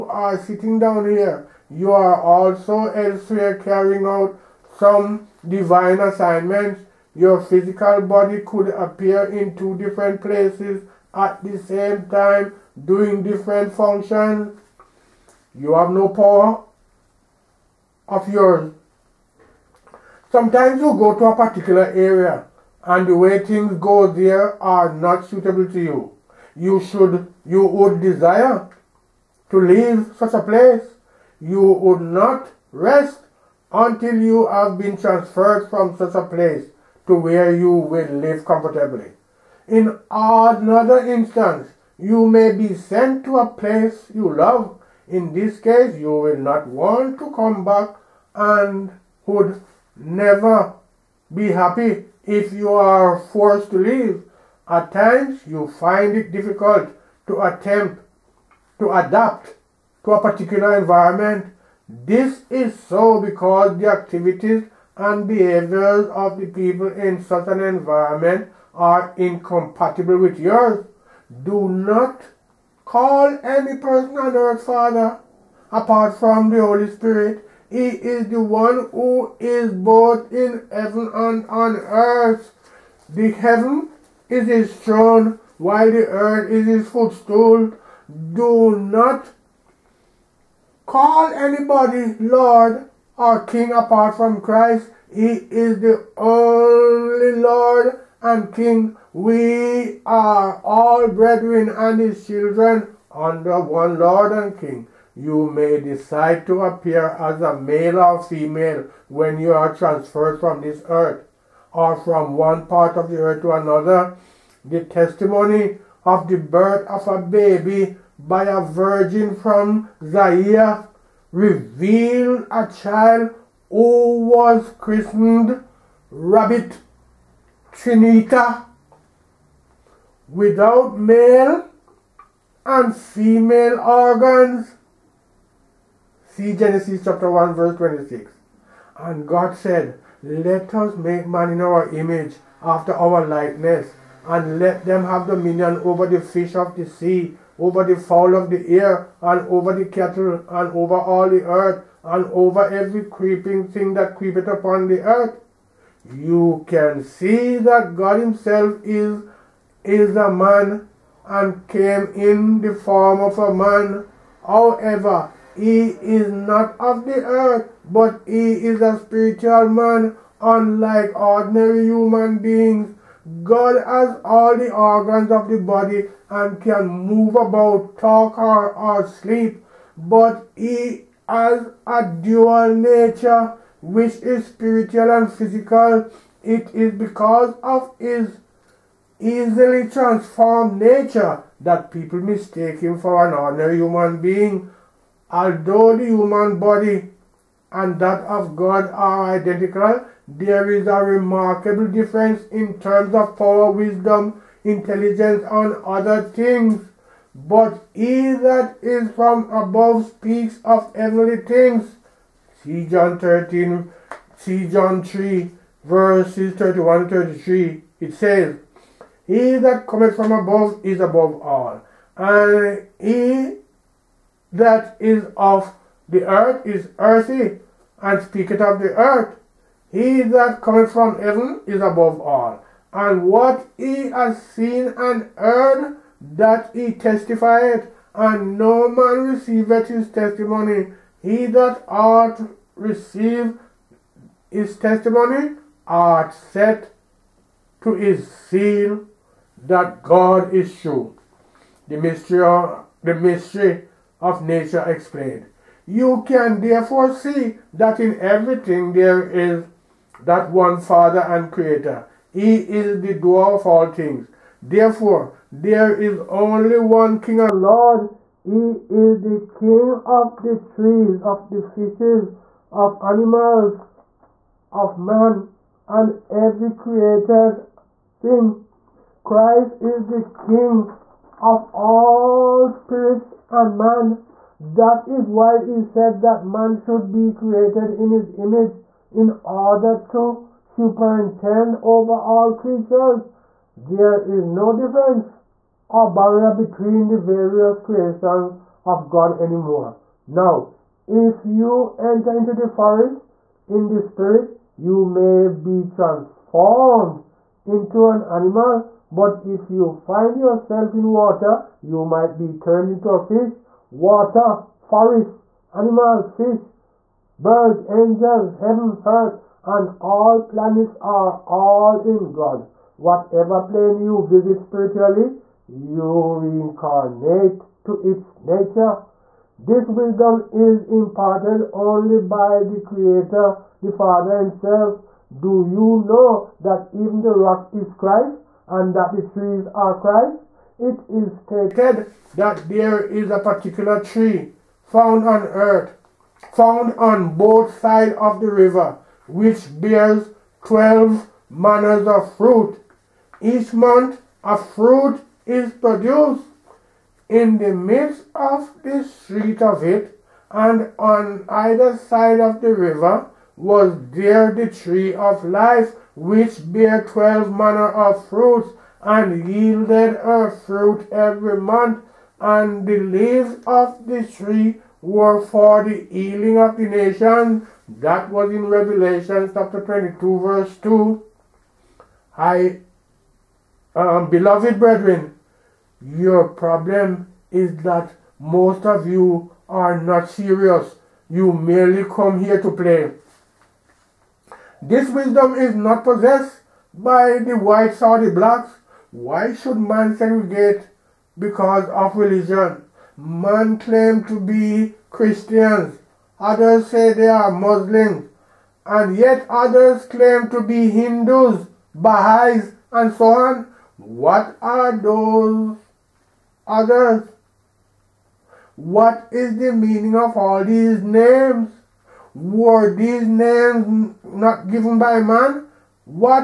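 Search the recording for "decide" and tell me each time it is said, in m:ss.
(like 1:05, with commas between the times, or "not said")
1:45.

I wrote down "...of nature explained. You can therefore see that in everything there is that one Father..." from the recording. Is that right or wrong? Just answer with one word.
right.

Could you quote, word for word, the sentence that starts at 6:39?
Why should man segregate because of religion?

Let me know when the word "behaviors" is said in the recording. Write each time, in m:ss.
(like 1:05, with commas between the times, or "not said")
1:05.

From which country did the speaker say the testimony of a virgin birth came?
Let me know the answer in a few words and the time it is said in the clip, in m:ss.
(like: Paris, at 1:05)
Zaire, at 2:00.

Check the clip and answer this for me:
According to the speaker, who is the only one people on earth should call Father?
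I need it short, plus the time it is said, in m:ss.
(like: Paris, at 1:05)
The Holy Spirit, at 1:16.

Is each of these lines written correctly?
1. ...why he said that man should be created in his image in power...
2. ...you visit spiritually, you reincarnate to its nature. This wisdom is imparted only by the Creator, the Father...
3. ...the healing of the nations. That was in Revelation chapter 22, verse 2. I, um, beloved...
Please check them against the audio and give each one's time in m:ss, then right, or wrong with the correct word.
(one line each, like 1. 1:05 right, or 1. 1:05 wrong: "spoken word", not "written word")
1. 4:45 wrong: "order", not "power"
2. 5:24 right
3. 6:15 right.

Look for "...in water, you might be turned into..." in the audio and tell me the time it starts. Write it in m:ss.
5:10.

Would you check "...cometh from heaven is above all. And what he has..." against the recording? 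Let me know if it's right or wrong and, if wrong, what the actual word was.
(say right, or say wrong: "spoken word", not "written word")
right.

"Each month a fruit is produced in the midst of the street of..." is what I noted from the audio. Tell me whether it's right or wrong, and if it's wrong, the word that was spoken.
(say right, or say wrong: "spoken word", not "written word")
right.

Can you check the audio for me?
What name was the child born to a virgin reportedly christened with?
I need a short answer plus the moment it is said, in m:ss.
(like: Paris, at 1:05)
Rabbit Trinita, at 2:06.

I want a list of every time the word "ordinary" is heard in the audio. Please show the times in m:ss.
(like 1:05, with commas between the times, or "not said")
2:51, 3:13.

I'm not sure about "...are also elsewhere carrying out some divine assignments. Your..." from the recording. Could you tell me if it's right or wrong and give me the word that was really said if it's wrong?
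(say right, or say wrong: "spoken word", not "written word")
right.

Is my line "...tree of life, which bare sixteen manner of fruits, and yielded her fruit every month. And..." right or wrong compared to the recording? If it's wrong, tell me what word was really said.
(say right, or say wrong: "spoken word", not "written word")
wrong: "twelve", not "sixteen".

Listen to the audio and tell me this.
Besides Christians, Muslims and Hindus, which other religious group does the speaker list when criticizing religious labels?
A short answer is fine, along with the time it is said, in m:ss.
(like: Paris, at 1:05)
Baha'is, at 6:51.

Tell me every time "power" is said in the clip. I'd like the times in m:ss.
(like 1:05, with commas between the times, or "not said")
0:16, 3:23.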